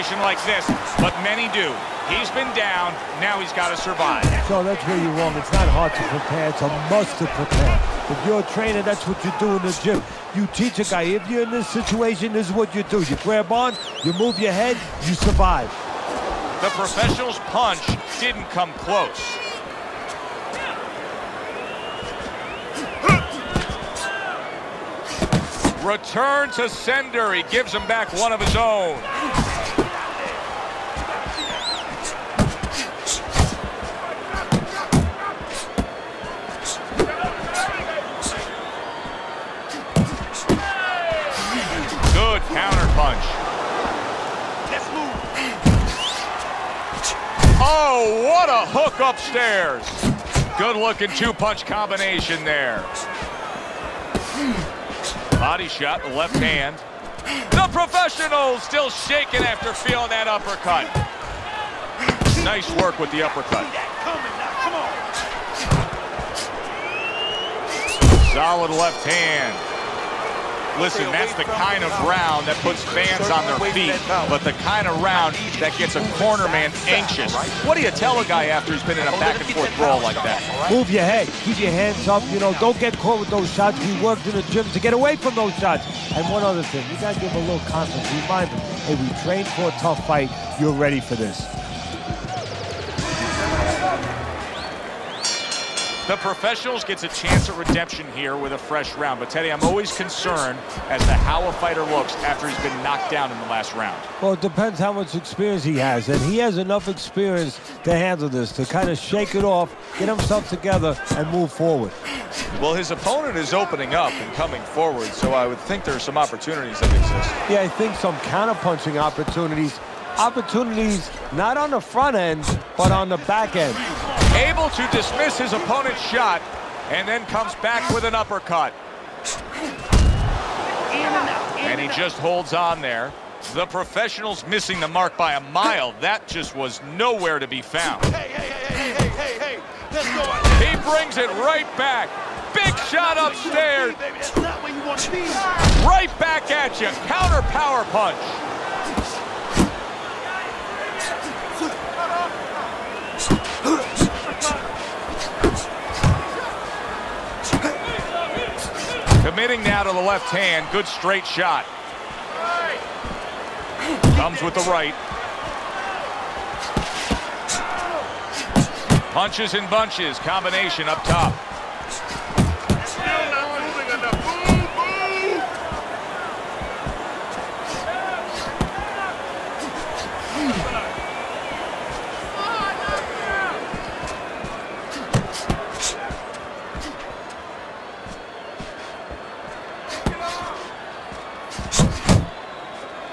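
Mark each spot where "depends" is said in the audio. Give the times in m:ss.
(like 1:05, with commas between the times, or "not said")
1:44.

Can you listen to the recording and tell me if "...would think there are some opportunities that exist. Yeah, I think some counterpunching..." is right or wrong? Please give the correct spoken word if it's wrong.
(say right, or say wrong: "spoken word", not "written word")
right.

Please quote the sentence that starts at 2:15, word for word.
That just was nowhere to be found.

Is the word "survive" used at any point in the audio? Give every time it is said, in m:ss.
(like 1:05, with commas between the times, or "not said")
0:03, 0:15.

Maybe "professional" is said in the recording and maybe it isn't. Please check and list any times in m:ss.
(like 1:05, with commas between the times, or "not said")
0:16, 0:57, 1:36, 2:13.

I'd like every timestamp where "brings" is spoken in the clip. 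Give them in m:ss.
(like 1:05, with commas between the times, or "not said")
2:20.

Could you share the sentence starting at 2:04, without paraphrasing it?
Able to dismiss his opponent's shot and then comes back with an uppercut.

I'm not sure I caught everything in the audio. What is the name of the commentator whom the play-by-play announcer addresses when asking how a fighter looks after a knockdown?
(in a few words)
Teddy.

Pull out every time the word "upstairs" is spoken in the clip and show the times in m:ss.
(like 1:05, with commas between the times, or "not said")
0:48, 2:23.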